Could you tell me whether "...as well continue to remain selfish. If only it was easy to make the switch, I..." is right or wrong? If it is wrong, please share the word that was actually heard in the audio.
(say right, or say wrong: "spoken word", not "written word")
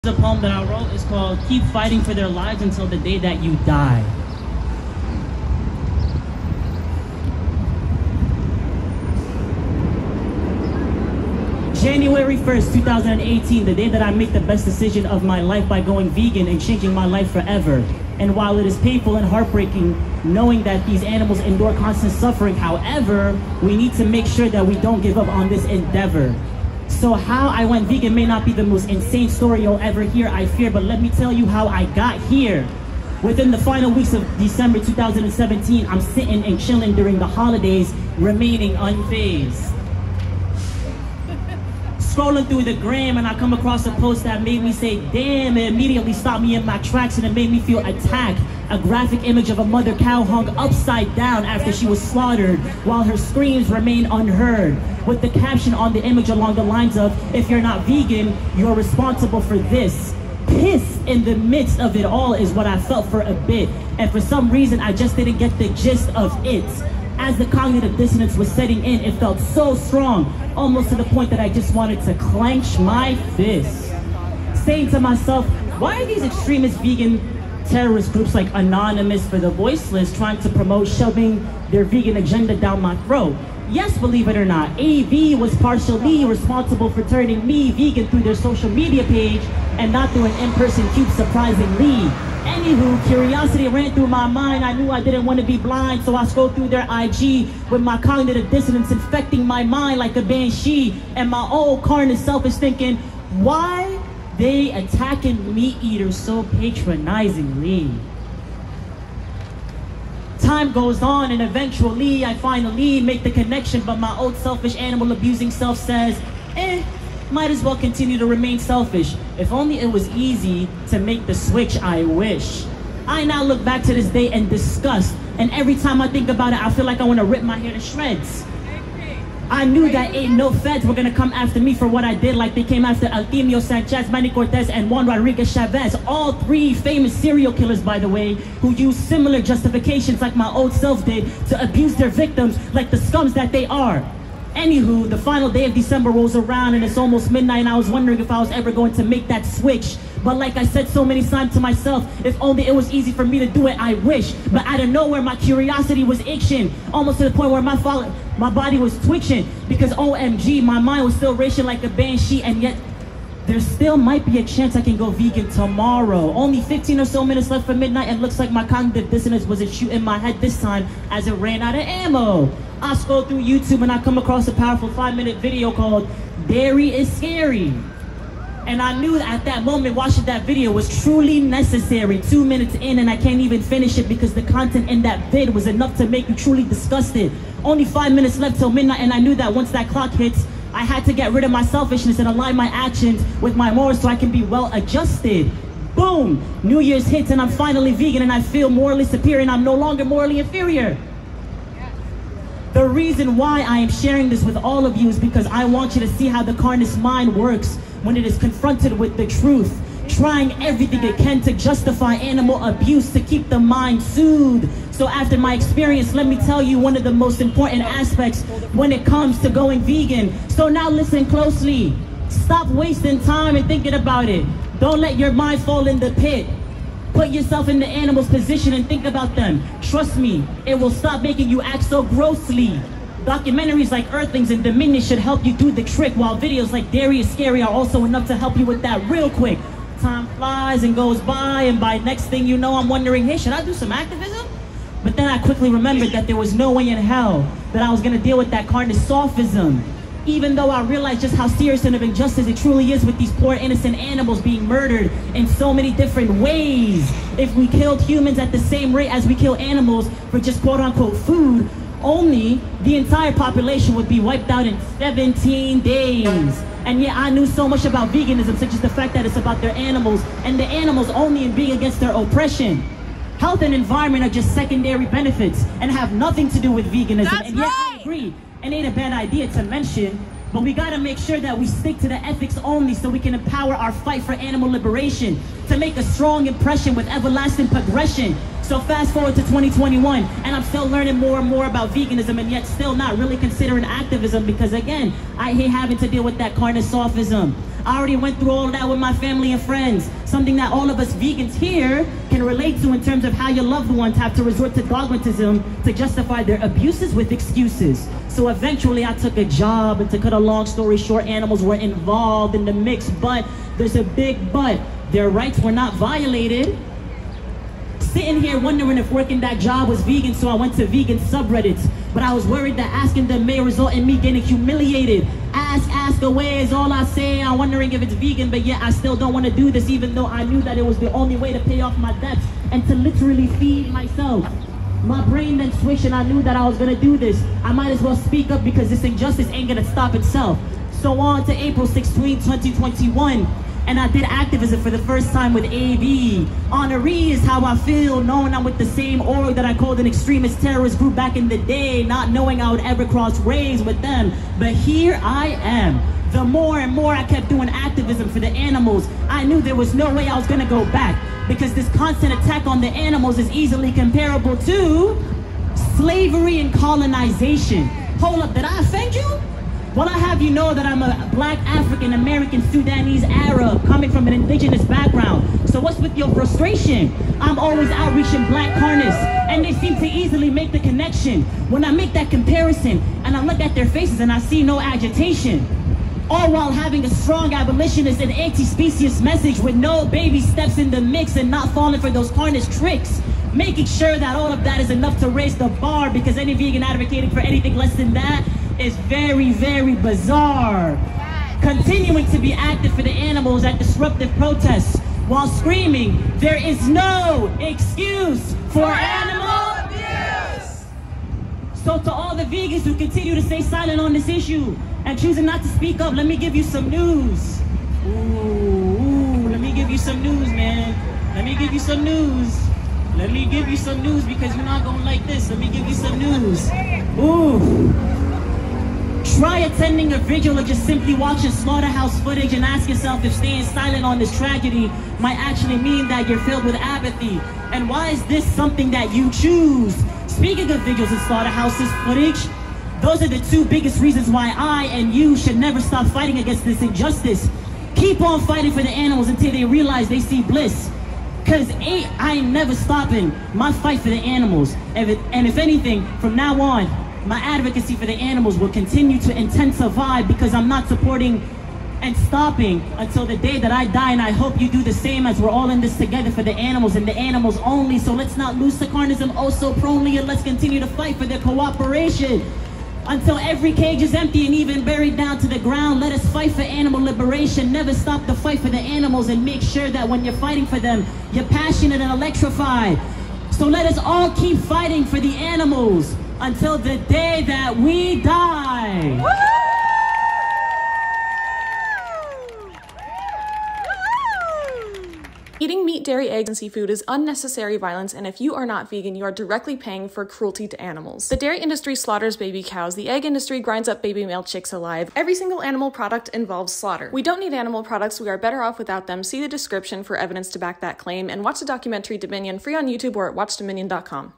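right.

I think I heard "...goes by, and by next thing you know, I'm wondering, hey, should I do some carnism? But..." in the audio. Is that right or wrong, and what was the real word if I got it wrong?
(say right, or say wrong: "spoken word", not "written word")
wrong: "activism", not "carnism".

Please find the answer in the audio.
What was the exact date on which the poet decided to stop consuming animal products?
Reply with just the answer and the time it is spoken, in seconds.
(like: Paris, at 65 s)
January 1st, 2018, at 11 s.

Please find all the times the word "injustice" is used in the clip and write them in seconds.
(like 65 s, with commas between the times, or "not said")
252 s, 339 s, 446 s.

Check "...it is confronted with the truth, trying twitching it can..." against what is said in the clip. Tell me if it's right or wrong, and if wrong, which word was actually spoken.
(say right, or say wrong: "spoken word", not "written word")
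wrong: "everything", not "twitching".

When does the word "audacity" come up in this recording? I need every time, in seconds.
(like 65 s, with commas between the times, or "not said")
not said.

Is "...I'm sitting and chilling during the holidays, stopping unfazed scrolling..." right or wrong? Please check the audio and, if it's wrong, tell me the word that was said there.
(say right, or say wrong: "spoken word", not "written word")
wrong: "remaining", not "stopping".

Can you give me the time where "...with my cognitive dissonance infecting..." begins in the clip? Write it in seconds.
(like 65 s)
97 s.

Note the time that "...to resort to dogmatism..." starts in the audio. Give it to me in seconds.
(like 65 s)
304 s.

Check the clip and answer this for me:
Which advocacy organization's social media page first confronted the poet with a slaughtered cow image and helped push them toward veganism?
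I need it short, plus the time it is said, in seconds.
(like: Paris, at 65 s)
Anonymous for the Voiceless, at 78 s.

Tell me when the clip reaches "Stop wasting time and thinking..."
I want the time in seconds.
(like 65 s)
222 s.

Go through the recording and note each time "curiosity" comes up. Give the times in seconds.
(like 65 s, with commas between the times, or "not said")
93 s, 155 s.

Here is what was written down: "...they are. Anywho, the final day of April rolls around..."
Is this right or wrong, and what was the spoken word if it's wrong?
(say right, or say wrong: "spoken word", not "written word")
wrong: "December", not "April".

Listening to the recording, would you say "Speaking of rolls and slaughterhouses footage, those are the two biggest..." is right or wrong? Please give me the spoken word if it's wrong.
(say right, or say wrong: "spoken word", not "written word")
wrong: "vigils", not "rolls".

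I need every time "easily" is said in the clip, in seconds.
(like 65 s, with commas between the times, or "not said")
363 s, 380 s.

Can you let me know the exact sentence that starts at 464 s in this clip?
And I hope you do the same as we're all in this together for the animals and the animals only.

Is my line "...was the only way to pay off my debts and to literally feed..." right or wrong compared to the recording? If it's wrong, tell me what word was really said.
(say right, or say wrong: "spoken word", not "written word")
right.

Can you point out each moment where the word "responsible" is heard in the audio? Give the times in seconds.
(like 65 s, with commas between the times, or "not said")
58 s, 86 s.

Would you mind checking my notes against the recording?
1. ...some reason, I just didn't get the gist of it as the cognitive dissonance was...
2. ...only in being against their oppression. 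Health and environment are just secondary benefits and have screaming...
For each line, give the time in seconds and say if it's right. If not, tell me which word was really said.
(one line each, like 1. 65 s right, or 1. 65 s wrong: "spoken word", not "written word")
1. 64 s right
2. 271 s wrong: "nothing", not "screaming".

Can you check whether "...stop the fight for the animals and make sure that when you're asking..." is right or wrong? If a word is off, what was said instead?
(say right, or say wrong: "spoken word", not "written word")
wrong: "fighting", not "asking".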